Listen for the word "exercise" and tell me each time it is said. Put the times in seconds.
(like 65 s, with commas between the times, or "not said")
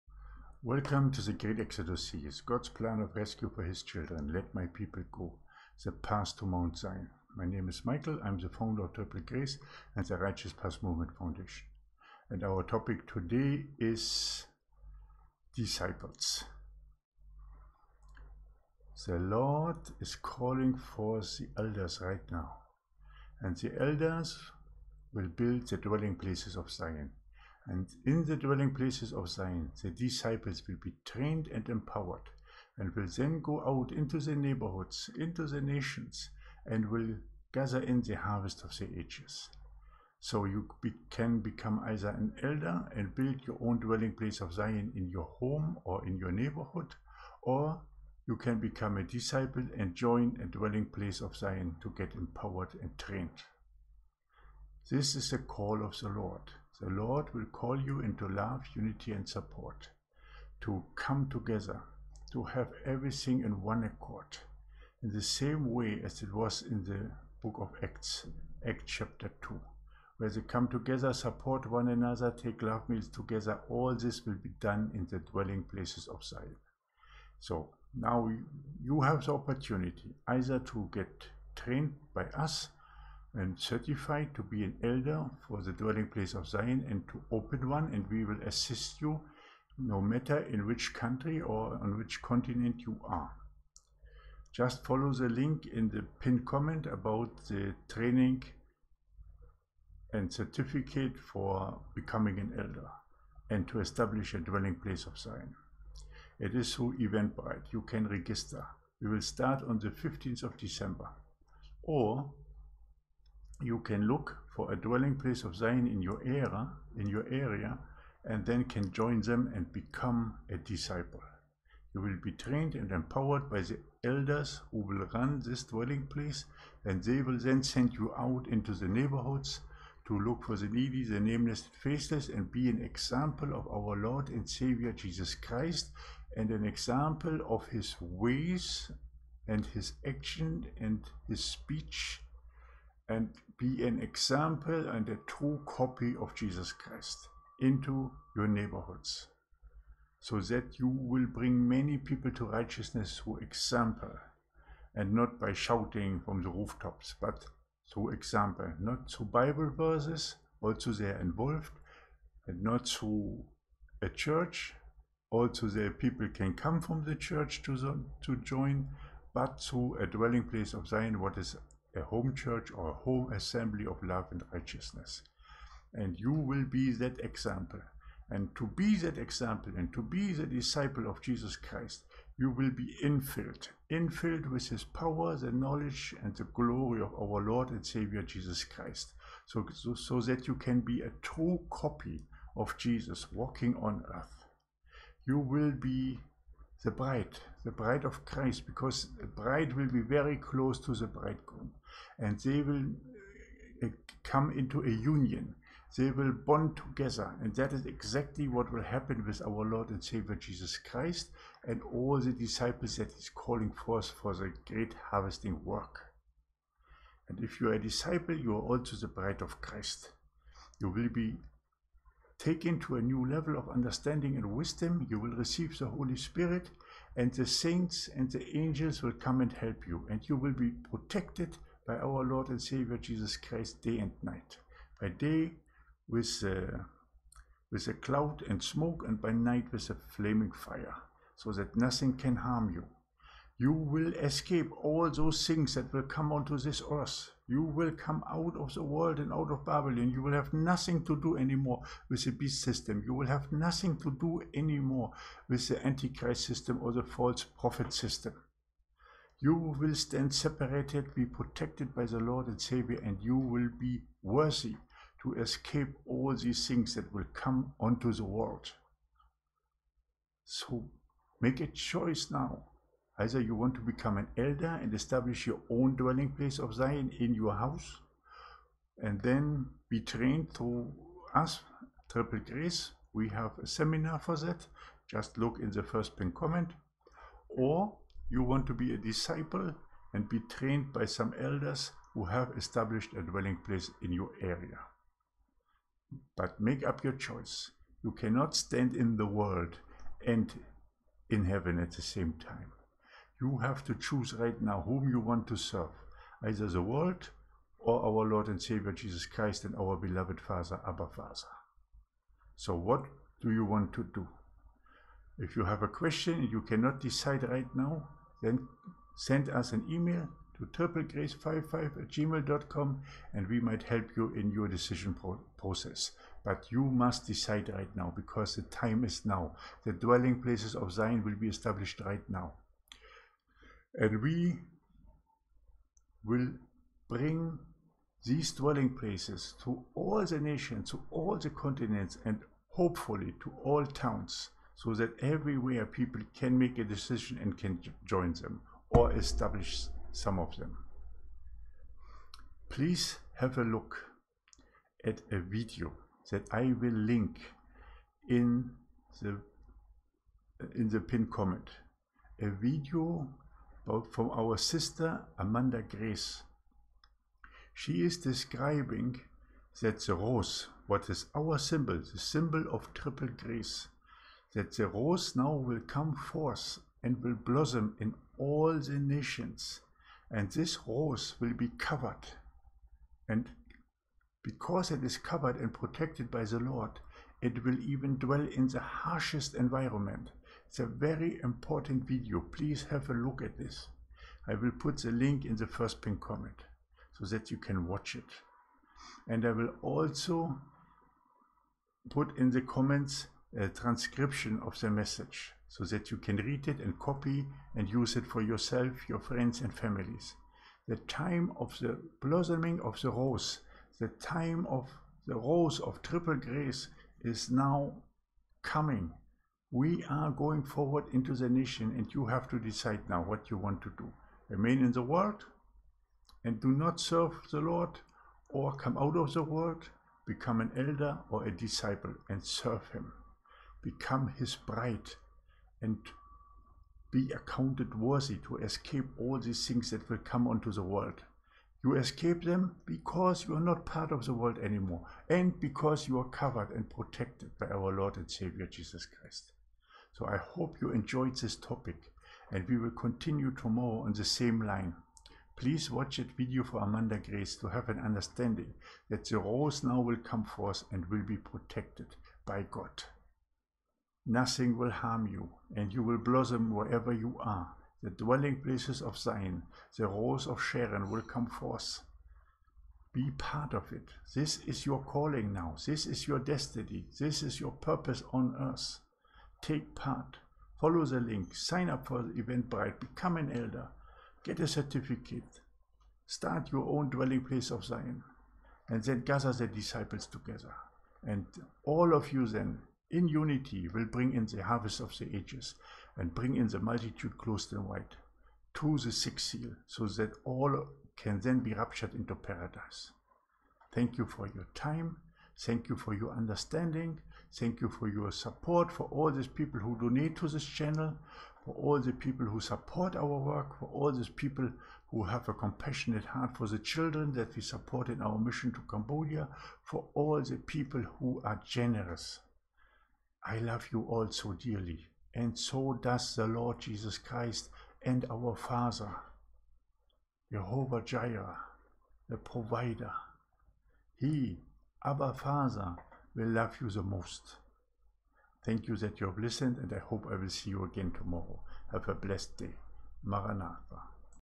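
not said.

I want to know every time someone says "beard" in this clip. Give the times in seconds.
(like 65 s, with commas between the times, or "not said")
not said.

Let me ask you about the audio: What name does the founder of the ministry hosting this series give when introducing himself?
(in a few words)
Maikel.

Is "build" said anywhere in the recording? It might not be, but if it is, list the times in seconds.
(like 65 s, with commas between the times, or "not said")
25 s, 43 s.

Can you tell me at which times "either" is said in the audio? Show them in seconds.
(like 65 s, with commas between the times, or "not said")
41 s, 80 s, 273 s, 306 s.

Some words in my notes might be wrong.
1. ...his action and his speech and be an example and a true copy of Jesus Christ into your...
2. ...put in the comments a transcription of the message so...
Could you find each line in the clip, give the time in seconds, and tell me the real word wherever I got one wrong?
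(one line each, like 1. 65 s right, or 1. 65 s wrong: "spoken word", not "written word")
1. 139 s right
2. 402 s right.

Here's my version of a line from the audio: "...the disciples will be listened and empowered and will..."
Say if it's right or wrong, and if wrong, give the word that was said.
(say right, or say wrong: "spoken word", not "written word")
wrong: "trained", not "listened".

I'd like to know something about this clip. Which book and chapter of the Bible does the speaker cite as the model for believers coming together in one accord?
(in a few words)
Acts chapter 2.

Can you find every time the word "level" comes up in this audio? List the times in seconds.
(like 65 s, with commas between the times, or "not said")
223 s.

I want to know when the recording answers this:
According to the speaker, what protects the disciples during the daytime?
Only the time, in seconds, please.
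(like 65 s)
237 s.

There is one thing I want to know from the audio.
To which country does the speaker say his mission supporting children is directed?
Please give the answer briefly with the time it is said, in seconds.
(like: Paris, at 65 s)
Cambodia, at 518 s.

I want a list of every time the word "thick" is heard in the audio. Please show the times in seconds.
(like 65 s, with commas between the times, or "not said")
not said.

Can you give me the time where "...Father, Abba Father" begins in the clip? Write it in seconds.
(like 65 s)
310 s.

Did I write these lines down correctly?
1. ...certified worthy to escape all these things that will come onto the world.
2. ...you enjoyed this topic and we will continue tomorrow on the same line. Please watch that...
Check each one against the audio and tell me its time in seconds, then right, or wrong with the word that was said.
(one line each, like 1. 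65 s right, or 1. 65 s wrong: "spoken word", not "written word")
1. 437 s wrong: "accounted", not "certified"
2. 450 s right.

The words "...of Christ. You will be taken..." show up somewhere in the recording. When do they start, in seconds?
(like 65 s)
219 s.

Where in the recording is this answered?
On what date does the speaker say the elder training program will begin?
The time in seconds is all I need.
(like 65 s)
109 s.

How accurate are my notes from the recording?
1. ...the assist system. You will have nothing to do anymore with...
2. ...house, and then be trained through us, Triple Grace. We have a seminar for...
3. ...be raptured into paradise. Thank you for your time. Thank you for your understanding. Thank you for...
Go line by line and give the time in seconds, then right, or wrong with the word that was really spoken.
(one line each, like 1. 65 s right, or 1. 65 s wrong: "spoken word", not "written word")
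1. 252 s wrong: "beast", not "assist"
2. 277 s right
3. 501 s right.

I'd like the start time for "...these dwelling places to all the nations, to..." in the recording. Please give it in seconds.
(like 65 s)
338 s.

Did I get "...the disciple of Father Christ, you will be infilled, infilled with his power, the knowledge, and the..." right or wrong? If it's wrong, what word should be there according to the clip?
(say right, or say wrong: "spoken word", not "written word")
wrong: "Jesus", not "Father".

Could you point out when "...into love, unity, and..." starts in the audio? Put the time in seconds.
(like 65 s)
58 s.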